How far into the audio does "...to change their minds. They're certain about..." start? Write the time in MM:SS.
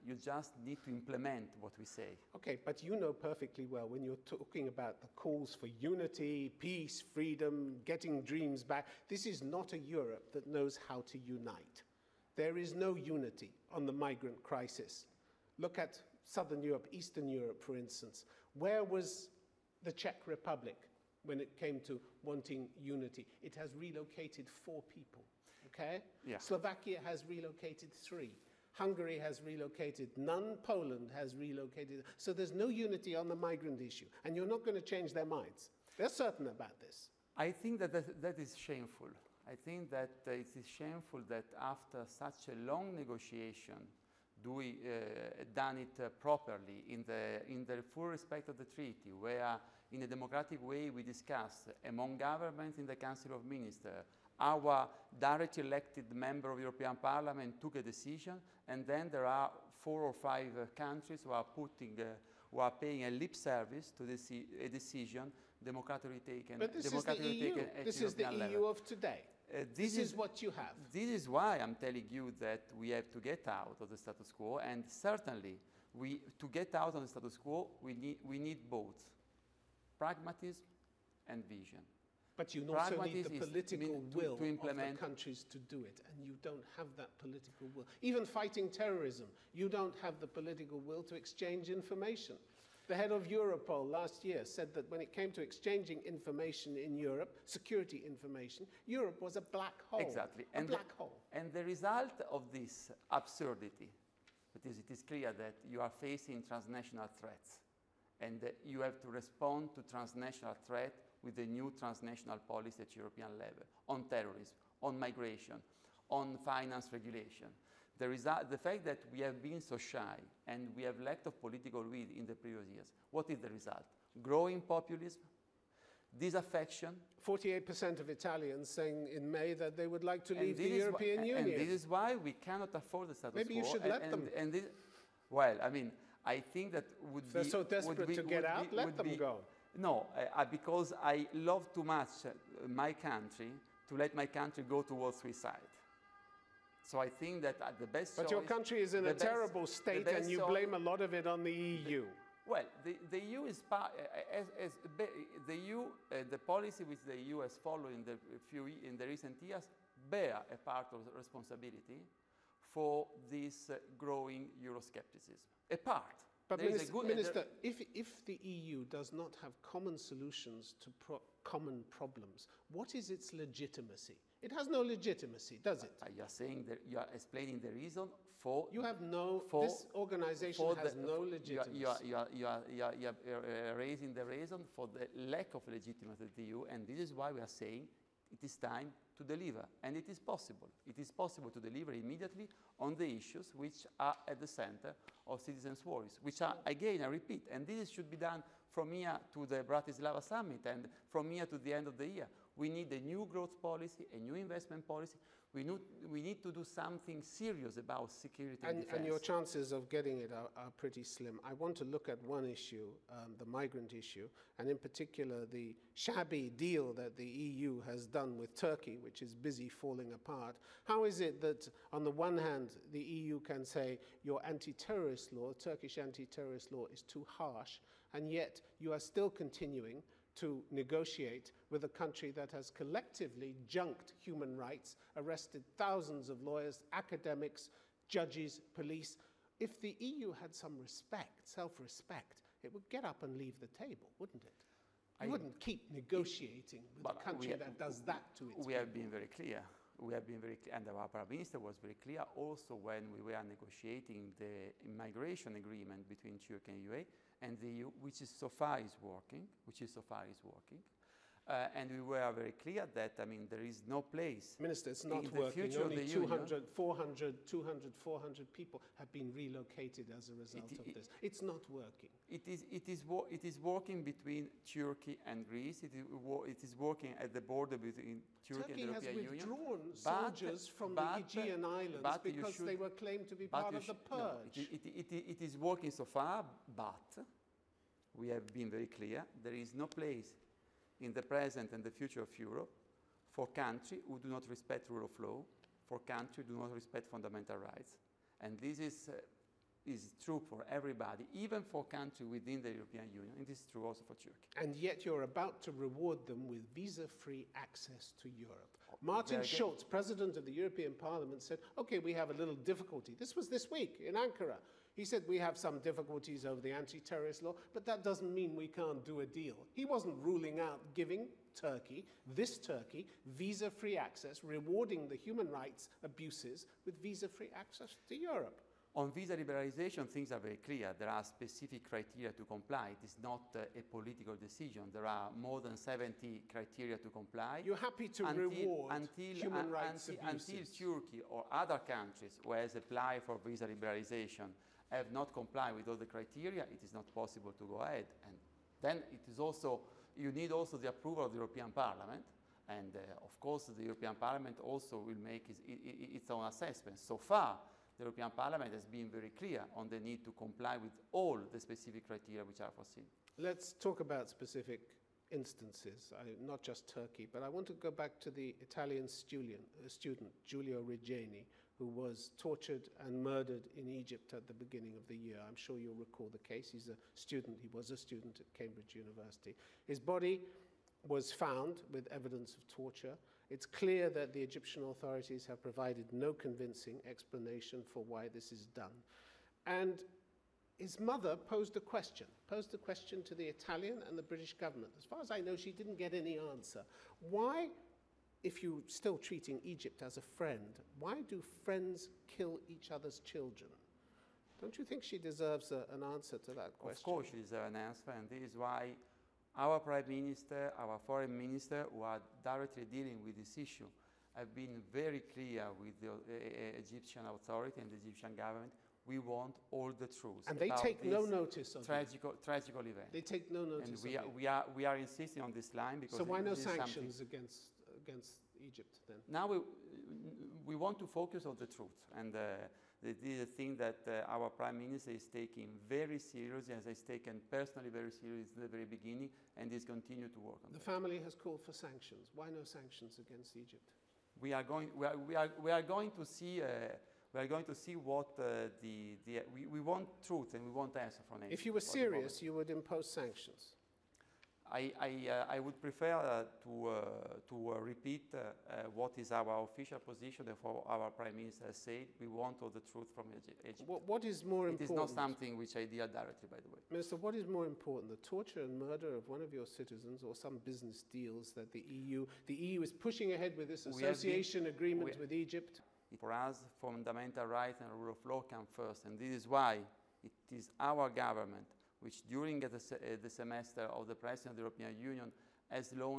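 00:34.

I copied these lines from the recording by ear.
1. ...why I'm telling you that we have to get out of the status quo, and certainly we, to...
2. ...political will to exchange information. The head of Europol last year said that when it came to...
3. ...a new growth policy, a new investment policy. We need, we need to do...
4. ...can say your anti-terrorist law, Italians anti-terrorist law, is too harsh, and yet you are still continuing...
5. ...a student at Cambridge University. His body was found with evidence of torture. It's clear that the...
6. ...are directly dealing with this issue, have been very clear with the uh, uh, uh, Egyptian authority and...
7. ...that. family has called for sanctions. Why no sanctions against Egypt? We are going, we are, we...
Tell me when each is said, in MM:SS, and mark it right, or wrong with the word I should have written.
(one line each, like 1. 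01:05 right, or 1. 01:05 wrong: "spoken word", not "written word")
1. 01:11 right
2. 01:30 right
3. 03:22 right
4. 03:43 wrong: "Turkish", not "Italians"
5. 06:17 right
6. 06:52 right
7. 07:20 right.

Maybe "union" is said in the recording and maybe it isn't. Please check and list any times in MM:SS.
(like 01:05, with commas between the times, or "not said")
02:11, 04:26, 04:39, 05:03, 08:05.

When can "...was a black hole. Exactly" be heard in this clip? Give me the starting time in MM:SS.
01:39.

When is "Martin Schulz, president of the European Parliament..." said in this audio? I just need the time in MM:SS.
05:08.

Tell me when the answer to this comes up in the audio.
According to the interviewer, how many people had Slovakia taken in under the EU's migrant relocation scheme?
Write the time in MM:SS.
00:26.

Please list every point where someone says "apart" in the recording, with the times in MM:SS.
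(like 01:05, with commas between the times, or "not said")
03:40.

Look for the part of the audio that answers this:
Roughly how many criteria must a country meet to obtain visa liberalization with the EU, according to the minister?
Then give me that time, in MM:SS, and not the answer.
05:35.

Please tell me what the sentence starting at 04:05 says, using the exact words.
You I wouldn't keep negotiating with a country have, that does that to its We people.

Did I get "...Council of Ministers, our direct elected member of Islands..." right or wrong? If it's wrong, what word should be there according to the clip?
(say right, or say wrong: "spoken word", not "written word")
wrong: "European", not "Islands".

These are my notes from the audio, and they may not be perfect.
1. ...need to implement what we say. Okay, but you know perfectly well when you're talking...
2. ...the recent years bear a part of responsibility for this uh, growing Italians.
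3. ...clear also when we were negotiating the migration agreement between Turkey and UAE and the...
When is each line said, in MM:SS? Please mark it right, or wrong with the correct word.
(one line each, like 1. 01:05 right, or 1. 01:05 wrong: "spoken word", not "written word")
1. 00:00 right
2. 02:38 wrong: "Euroscepticism", not "Italians"
3. 04:11 right.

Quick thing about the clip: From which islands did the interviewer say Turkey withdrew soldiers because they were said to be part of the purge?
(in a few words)
Aegean Islands.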